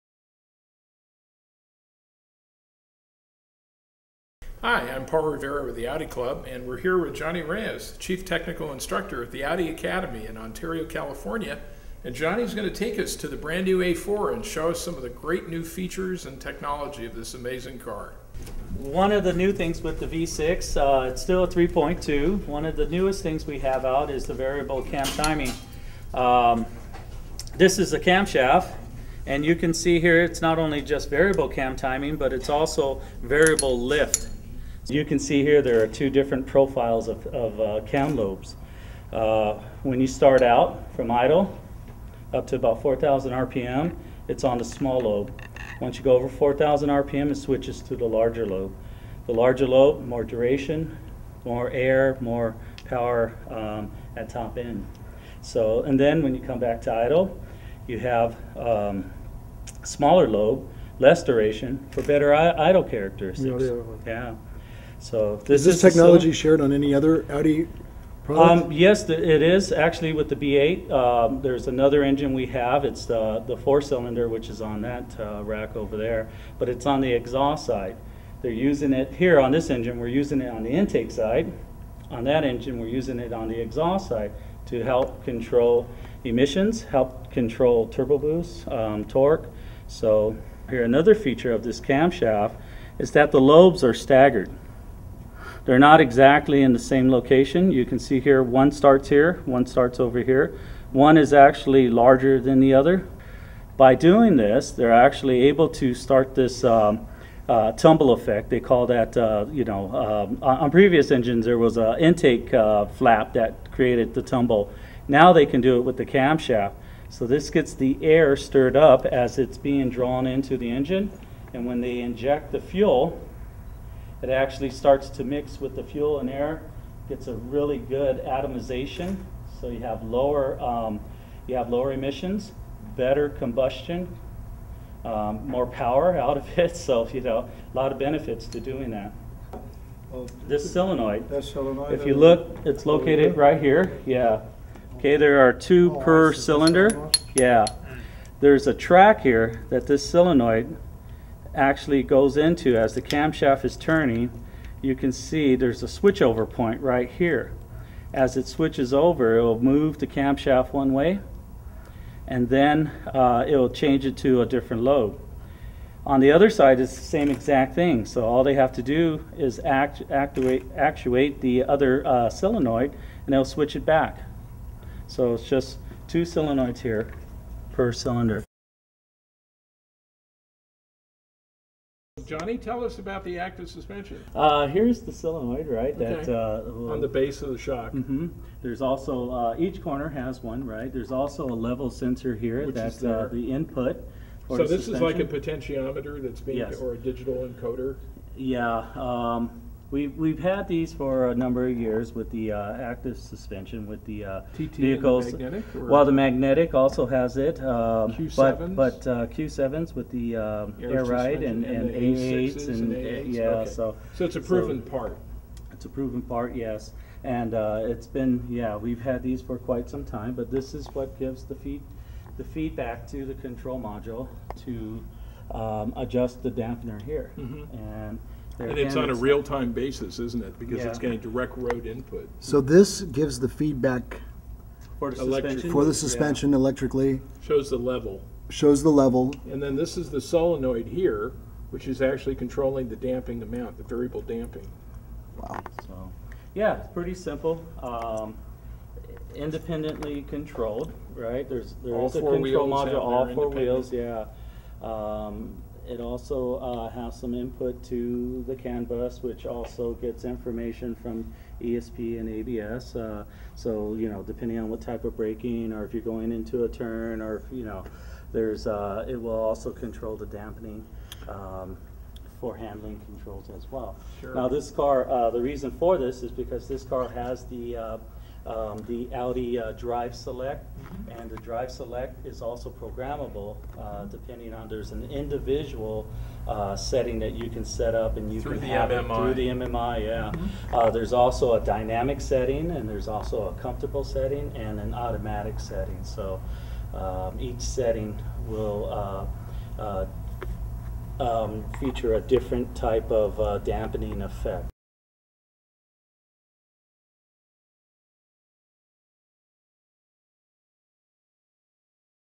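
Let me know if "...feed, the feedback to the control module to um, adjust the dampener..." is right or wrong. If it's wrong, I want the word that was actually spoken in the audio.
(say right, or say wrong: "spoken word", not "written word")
right.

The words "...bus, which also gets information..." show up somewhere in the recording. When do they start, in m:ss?
4:18.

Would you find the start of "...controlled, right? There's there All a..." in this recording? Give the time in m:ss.
4:10.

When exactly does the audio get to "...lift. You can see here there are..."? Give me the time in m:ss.
0:33.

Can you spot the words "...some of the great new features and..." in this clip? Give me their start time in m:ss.
0:14.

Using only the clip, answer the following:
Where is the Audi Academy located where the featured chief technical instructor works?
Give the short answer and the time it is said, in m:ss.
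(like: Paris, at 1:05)
Ontario, California, at 0:10.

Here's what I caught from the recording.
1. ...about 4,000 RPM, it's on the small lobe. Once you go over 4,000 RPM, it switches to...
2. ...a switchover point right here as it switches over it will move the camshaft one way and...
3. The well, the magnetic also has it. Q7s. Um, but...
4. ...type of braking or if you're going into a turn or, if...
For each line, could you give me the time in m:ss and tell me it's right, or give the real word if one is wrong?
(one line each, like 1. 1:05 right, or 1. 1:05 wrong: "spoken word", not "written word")
1. 0:42 right
2. 2:35 right
3. 3:25 right
4. 4:24 right.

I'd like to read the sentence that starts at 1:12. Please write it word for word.
It's the four-cylinder, which is on that uh, rack over there, but it's on the exhaust side.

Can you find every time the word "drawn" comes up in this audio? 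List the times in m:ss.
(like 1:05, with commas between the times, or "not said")
1:59.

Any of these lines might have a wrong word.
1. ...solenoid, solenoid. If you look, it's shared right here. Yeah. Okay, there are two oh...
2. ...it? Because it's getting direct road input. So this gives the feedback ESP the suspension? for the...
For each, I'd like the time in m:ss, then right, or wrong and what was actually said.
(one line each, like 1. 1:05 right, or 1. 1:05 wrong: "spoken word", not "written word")
1. 2:20 wrong: "located", not "shared"
2. 3:50 wrong: "For", not "ESP".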